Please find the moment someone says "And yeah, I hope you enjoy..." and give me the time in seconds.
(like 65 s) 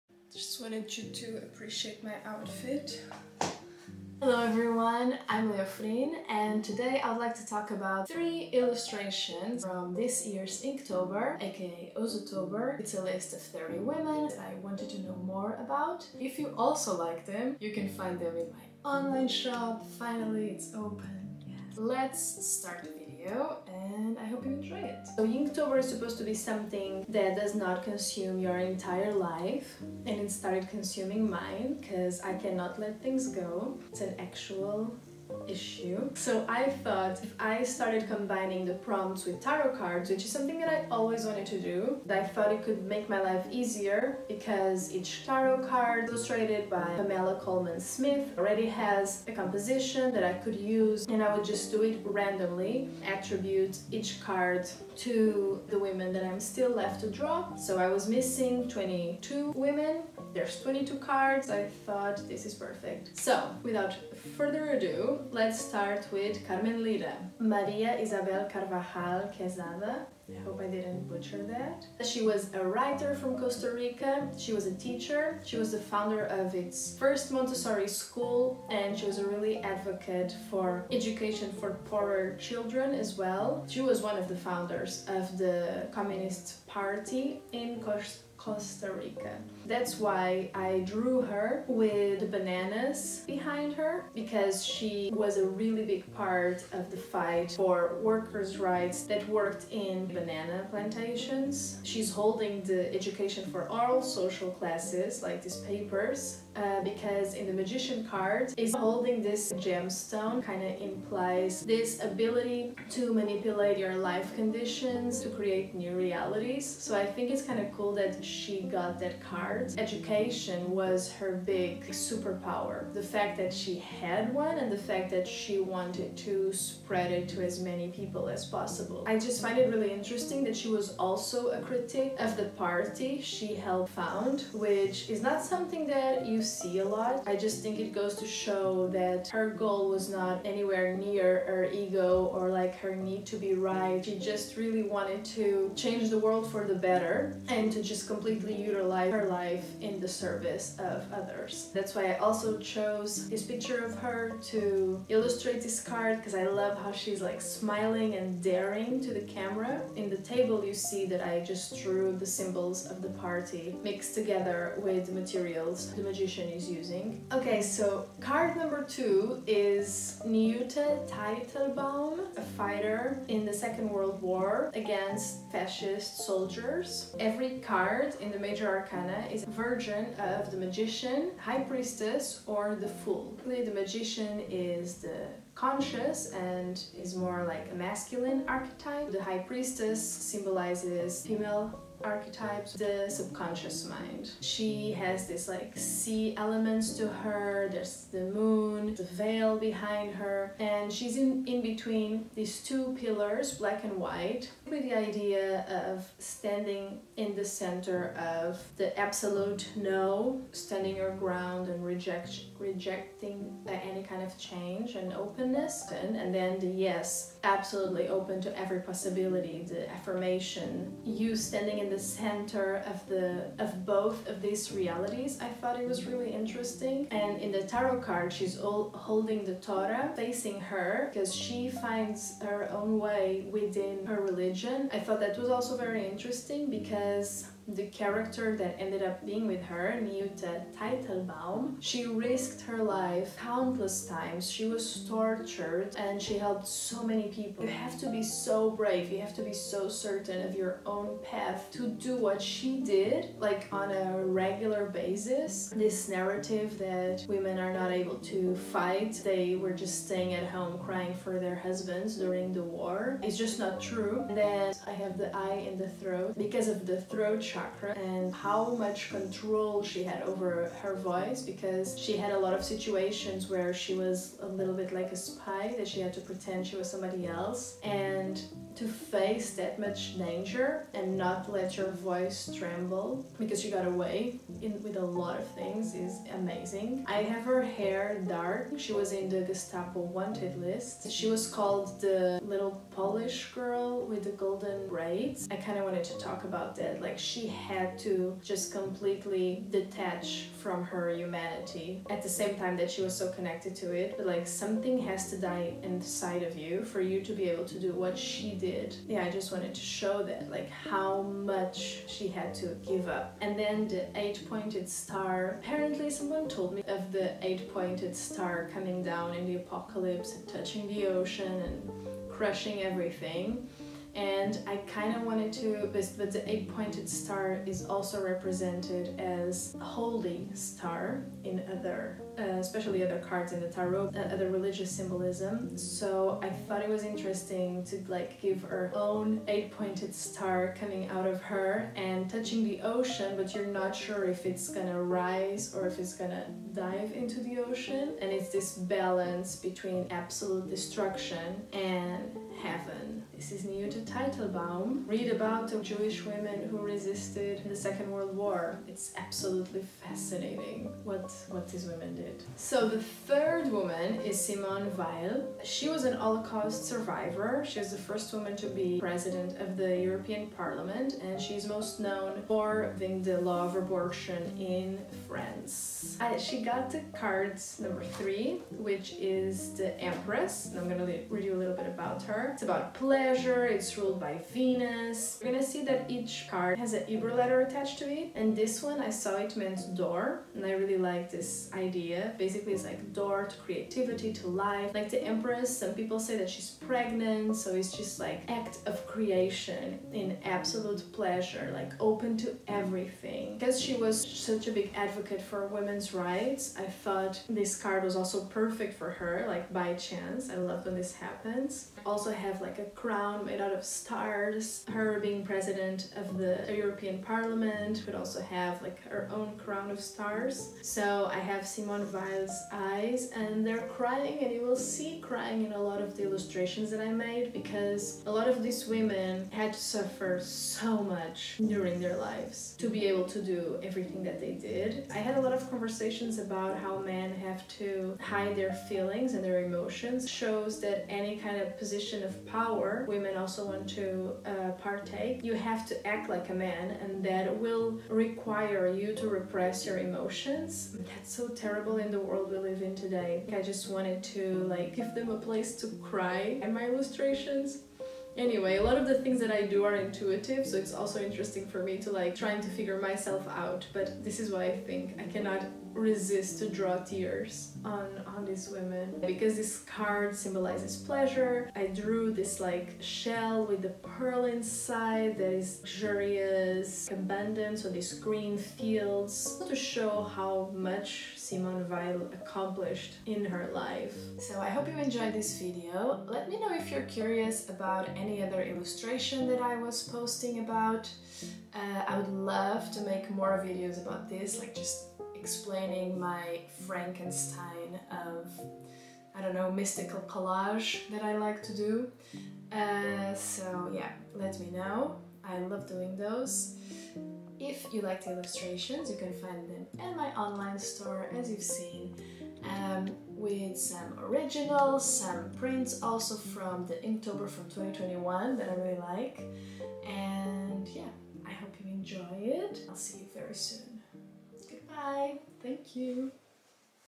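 520 s.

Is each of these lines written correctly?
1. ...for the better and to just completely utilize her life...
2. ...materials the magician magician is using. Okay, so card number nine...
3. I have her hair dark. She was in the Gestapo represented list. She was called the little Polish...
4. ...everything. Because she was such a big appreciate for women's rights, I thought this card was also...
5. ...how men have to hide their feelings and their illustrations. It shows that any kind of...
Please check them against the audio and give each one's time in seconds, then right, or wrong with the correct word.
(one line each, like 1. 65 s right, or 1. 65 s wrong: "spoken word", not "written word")
1. 146 s right
2. 165 s wrong: "two", not "nine"
3. 287 s wrong: "wanted", not "represented"
4. 402 s wrong: "advocate", not "appreciate"
5. 436 s wrong: "emotions", not "illustrations".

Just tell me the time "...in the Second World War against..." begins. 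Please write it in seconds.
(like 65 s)
173 s.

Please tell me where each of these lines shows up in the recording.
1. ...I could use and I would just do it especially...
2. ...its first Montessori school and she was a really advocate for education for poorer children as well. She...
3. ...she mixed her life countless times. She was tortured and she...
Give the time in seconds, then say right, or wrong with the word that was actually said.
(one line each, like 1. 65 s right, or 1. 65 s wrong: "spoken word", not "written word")
1. 50 s wrong: "randomly", not "especially"
2. 76 s right
3. 241 s wrong: "risked", not "mixed".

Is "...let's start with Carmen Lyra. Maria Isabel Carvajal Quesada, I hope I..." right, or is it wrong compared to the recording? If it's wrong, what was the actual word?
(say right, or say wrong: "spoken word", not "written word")
right.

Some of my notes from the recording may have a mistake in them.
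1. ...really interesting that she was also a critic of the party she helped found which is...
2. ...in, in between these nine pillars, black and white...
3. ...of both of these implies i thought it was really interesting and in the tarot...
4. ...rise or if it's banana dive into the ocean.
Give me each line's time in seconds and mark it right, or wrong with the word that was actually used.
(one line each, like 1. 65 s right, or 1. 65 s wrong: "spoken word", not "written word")
1. 129 s right
2. 201 s wrong: "two", not "nine"
3. 223 s wrong: "realities", not "implies"
4. 345 s wrong: "gonna", not "banana".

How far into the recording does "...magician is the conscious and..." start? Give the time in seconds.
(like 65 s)
183 s.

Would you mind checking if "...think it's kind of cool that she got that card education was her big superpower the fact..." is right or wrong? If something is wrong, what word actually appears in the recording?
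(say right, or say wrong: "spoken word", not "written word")
right.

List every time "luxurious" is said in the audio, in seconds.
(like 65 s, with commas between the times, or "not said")
475 s.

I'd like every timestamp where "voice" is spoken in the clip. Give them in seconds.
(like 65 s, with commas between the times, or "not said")
270 s, 281 s.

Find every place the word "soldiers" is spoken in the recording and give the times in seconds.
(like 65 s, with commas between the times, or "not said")
176 s.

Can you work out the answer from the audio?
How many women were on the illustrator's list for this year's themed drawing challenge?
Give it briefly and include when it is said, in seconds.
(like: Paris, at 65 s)
30, at 13 s.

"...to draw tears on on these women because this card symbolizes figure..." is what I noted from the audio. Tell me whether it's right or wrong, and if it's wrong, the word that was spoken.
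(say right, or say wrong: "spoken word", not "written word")
wrong: "pleasure", not "figure".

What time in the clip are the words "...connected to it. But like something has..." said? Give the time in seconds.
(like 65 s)
303 s.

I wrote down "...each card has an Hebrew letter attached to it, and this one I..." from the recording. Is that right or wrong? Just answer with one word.
right.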